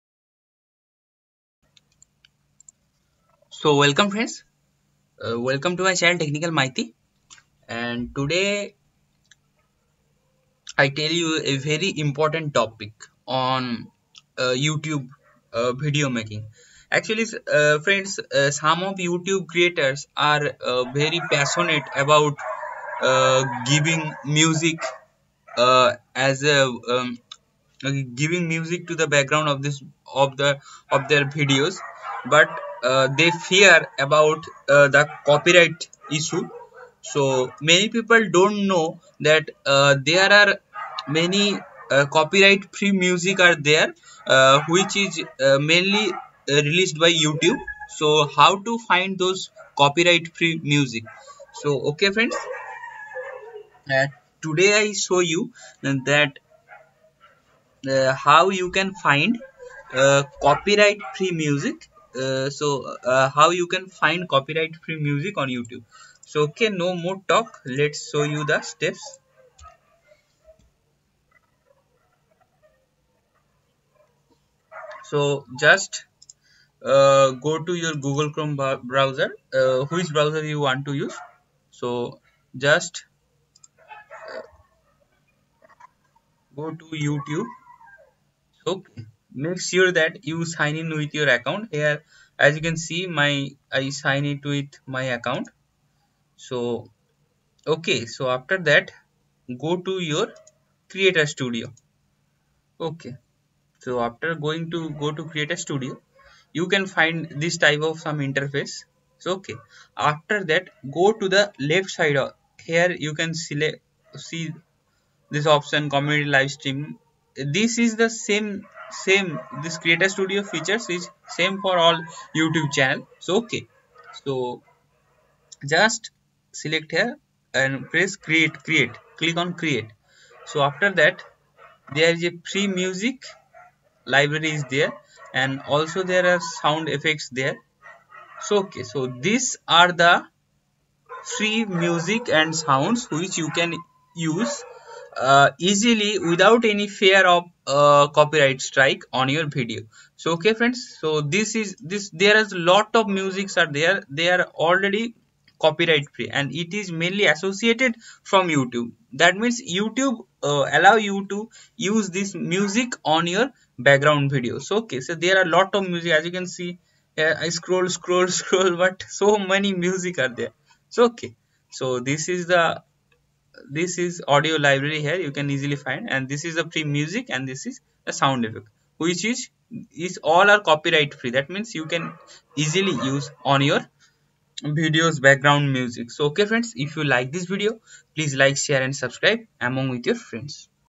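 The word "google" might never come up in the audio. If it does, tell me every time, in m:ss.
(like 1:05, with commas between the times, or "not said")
1:17.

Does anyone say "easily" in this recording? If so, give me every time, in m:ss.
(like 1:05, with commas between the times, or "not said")
2:25, 2:55, 3:02.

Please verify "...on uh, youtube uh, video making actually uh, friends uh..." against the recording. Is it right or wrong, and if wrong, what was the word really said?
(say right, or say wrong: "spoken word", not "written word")
right.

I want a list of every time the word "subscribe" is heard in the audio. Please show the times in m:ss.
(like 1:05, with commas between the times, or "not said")
3:08.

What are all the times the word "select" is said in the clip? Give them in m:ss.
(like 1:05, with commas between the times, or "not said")
1:53, 2:06.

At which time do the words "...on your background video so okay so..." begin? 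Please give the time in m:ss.
2:43.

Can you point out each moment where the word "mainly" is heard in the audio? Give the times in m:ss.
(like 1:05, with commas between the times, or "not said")
0:45, 2:36.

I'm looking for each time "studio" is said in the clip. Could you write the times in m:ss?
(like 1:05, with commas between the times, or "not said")
1:41, 1:45, 2:00.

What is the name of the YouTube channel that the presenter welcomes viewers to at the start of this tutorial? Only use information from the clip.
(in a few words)
Technical Maity.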